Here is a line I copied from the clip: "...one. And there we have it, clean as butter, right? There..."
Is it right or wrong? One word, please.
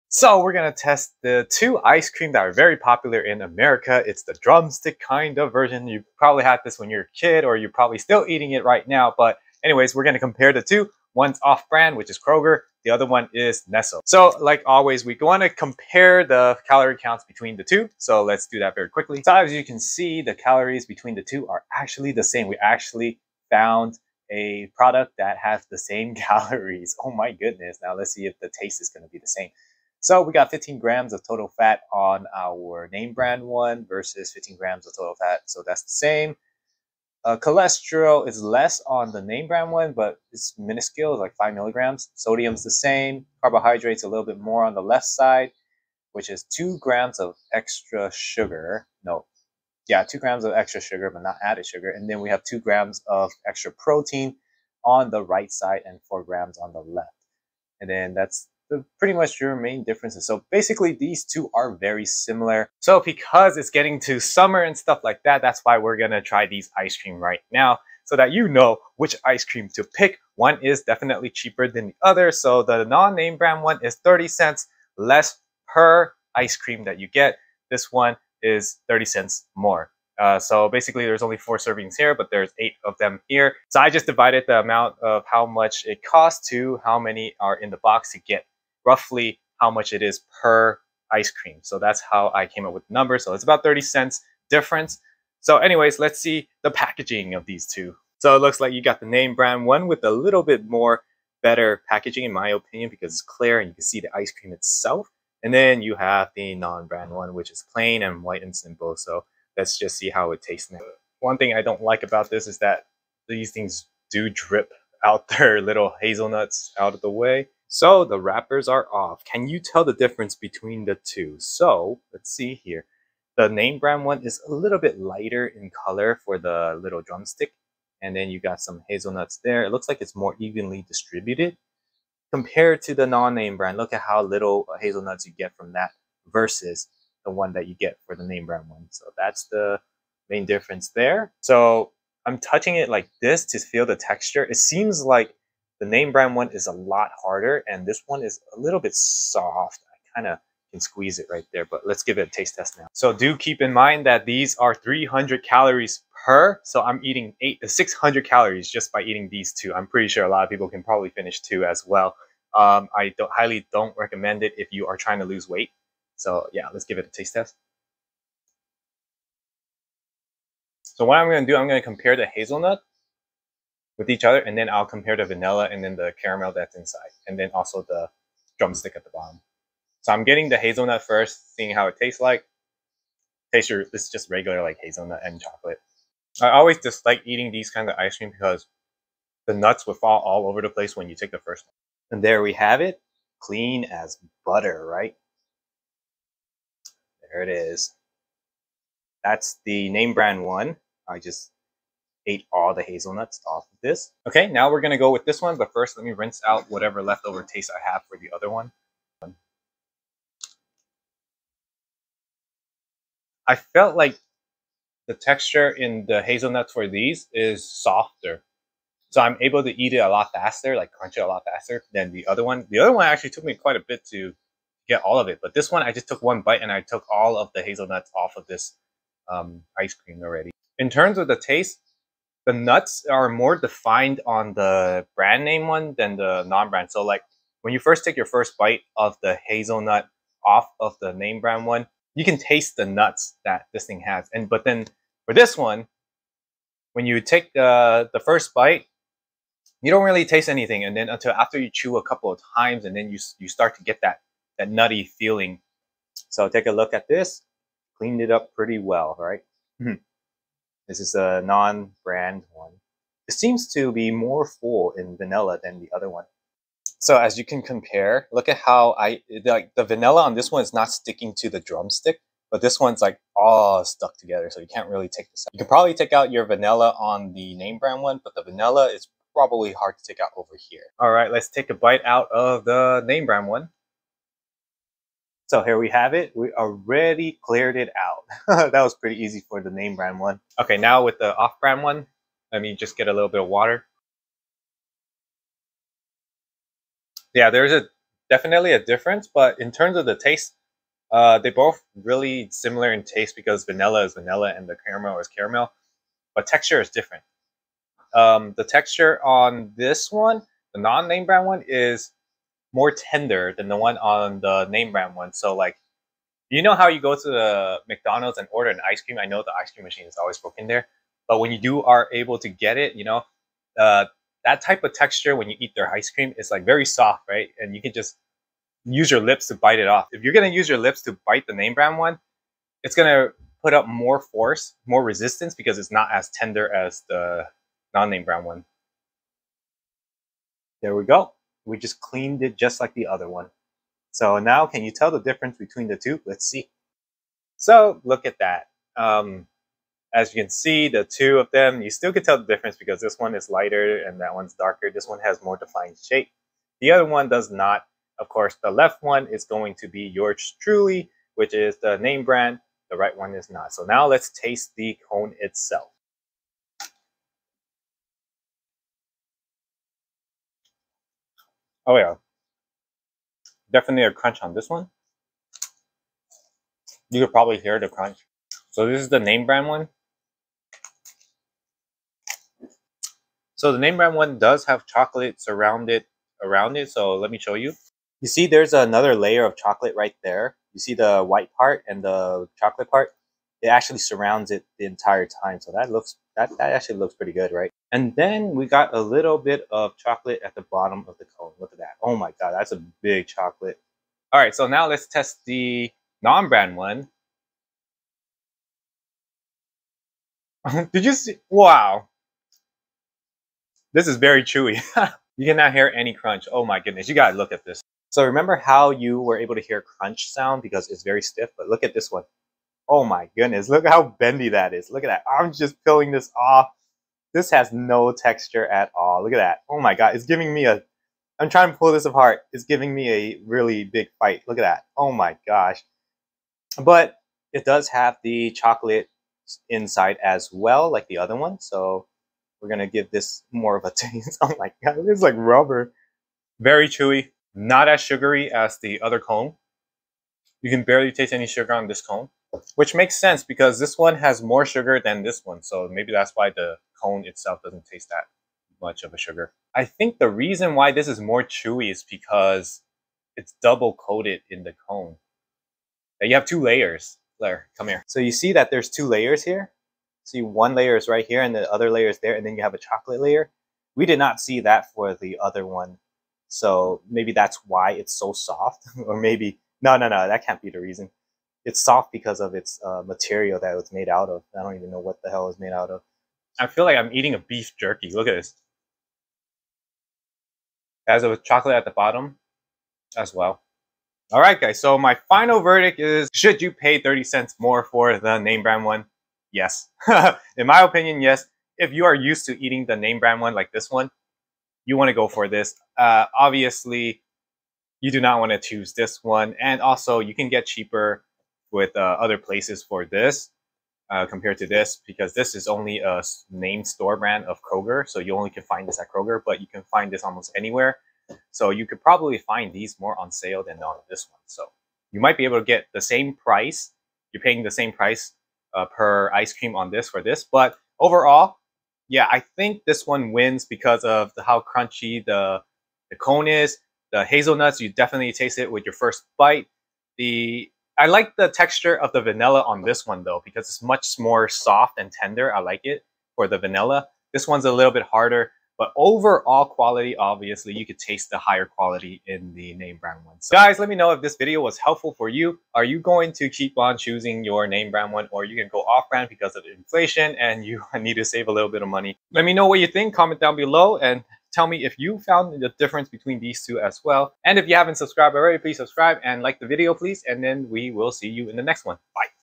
right.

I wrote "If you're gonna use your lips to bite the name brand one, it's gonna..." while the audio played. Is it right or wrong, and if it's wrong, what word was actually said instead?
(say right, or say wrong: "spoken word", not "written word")
right.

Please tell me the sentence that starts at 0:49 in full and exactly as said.
No, yeah, two grams of extra sugar, but not added sugar.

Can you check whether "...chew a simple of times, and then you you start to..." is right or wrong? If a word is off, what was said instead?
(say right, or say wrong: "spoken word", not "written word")
wrong: "couple", not "simple".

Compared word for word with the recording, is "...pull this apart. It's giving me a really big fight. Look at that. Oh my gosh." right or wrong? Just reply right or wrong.
right.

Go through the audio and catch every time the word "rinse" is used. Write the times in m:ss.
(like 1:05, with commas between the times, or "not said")
3:26.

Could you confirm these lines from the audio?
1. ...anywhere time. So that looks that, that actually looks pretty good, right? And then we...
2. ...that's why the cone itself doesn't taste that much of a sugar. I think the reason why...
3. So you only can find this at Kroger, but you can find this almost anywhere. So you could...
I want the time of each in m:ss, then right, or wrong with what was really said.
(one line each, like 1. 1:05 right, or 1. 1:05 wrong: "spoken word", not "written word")
1. 6:34 wrong: "entire", not "anywhere"
2. 7:36 right
3. 8:38 right.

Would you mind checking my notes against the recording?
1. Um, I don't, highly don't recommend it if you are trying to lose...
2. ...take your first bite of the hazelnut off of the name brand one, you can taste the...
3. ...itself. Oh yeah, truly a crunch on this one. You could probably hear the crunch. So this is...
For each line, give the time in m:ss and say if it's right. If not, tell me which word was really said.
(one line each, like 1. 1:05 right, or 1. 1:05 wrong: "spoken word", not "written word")
1. 2:42 right
2. 3:58 right
3. 6:05 wrong: "definitely", not "truly".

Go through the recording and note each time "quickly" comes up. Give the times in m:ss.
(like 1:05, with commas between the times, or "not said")
0:18.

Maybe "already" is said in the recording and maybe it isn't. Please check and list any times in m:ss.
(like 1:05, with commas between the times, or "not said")
3:50, 4:46, 9:28.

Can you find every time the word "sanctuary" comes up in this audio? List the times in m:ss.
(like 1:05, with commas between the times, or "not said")
not said.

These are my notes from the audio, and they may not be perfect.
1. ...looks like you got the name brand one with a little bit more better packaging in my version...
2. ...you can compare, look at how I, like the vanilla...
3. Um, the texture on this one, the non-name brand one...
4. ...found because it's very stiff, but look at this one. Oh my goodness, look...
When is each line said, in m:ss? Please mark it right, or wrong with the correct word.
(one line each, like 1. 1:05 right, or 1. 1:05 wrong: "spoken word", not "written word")
1. 1:38 wrong: "opinion", not "version"
2. 4:27 right
3. 5:08 right
4. 7:00 wrong: "sound", not "found".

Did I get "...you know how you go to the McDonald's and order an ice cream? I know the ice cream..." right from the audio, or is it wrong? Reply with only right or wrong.
right.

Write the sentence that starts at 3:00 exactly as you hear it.
So I'm getting the hazelnut first, seeing how it tastes like.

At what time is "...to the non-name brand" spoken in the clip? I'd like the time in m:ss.
2:12.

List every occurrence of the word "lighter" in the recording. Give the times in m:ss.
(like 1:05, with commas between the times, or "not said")
2:04, 5:53.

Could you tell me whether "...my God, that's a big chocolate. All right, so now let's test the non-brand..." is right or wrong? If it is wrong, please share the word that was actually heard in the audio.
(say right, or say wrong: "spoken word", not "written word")
right.